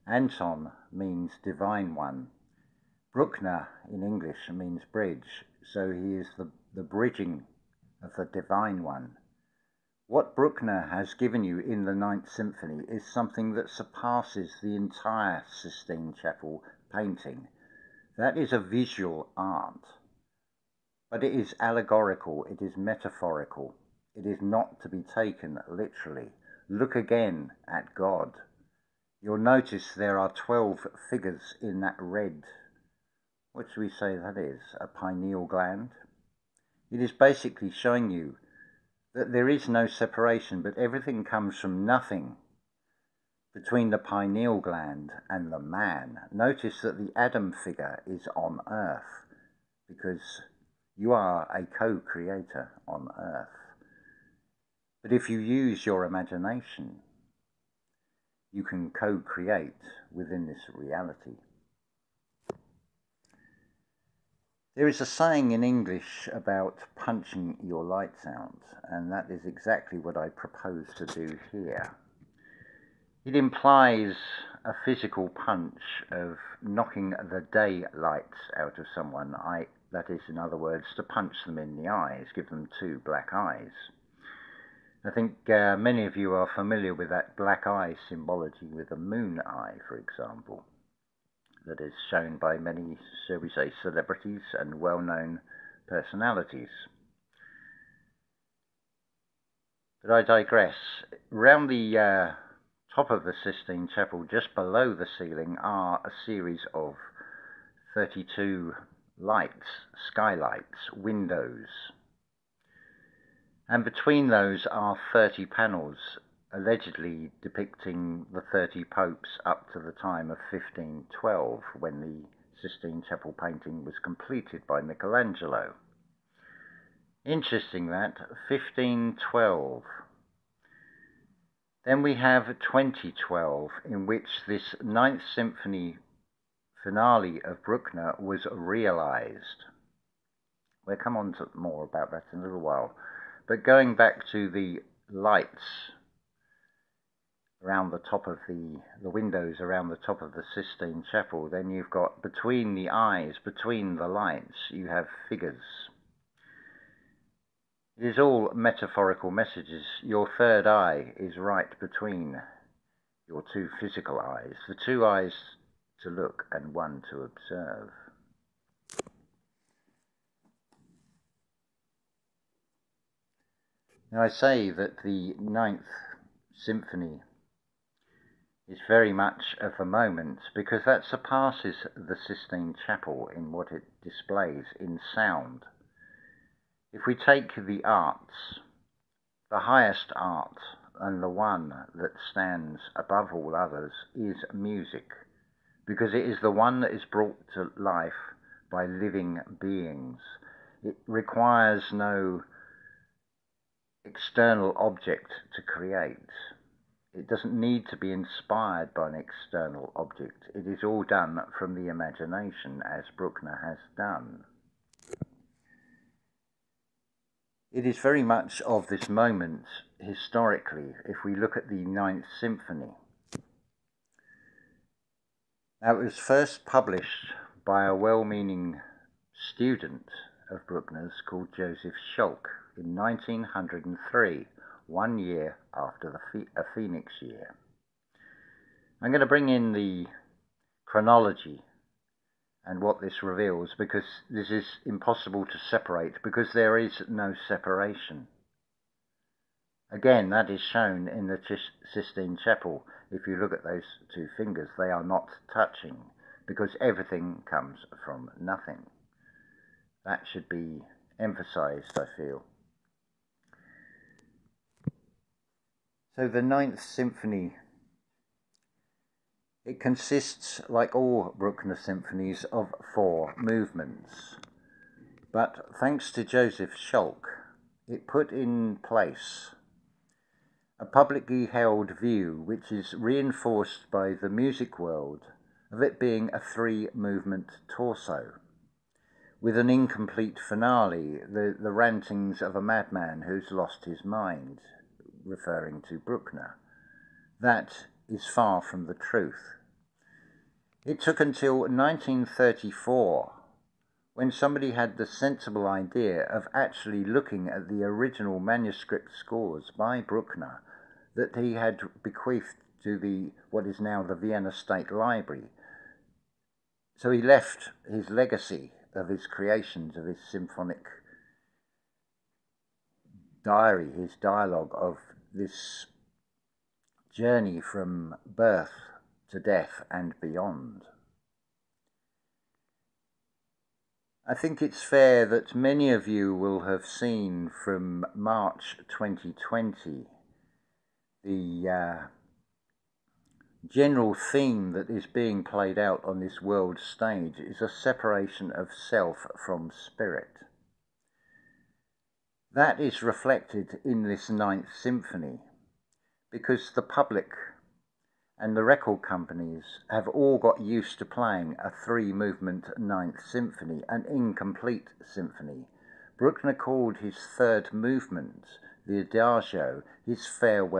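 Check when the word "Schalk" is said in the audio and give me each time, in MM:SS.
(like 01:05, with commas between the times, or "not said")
03:52, 04:36.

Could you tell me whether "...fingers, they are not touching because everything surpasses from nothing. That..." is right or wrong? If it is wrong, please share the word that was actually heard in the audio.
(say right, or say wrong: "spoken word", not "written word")
wrong: "comes", not "surpasses".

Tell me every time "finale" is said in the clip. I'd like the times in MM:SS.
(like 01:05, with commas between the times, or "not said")
02:16, 04:50.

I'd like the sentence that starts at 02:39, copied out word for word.
Your third eye is right between your two physical eyes, the two eyes to look and one to observe.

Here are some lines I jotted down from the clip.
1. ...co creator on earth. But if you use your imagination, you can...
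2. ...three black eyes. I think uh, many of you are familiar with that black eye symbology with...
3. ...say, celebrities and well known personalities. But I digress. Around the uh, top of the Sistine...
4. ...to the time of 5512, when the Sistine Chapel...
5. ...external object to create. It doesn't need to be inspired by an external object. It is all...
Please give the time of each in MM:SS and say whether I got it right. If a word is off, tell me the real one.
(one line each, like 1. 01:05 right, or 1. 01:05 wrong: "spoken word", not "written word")
1. 00:51 right
2. 01:22 wrong: "two", not "three"
3. 01:33 right
4. 01:59 wrong: "1512", not "5512"
5. 03:24 right.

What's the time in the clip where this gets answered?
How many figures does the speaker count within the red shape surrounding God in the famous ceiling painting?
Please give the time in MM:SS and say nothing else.
00:30.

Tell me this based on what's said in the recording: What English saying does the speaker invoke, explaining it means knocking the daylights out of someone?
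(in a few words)
punching your lights out.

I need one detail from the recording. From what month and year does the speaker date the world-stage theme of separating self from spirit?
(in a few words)
March 2020.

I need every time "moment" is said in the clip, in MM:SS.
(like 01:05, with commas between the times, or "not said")
02:59, 03:39.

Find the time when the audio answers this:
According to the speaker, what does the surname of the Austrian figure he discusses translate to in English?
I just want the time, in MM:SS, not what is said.
00:04.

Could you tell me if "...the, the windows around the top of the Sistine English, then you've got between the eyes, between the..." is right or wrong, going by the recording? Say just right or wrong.
wrong.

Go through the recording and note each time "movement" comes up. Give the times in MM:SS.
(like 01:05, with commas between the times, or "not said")
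04:33, 04:46, 06:02, 06:07.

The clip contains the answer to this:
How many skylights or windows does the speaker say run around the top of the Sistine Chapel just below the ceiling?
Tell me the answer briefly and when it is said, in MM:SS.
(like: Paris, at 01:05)
32, at 01:47.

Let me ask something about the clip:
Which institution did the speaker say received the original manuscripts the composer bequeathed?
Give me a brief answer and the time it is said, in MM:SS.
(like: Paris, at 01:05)
Vienna State Library, at 05:14.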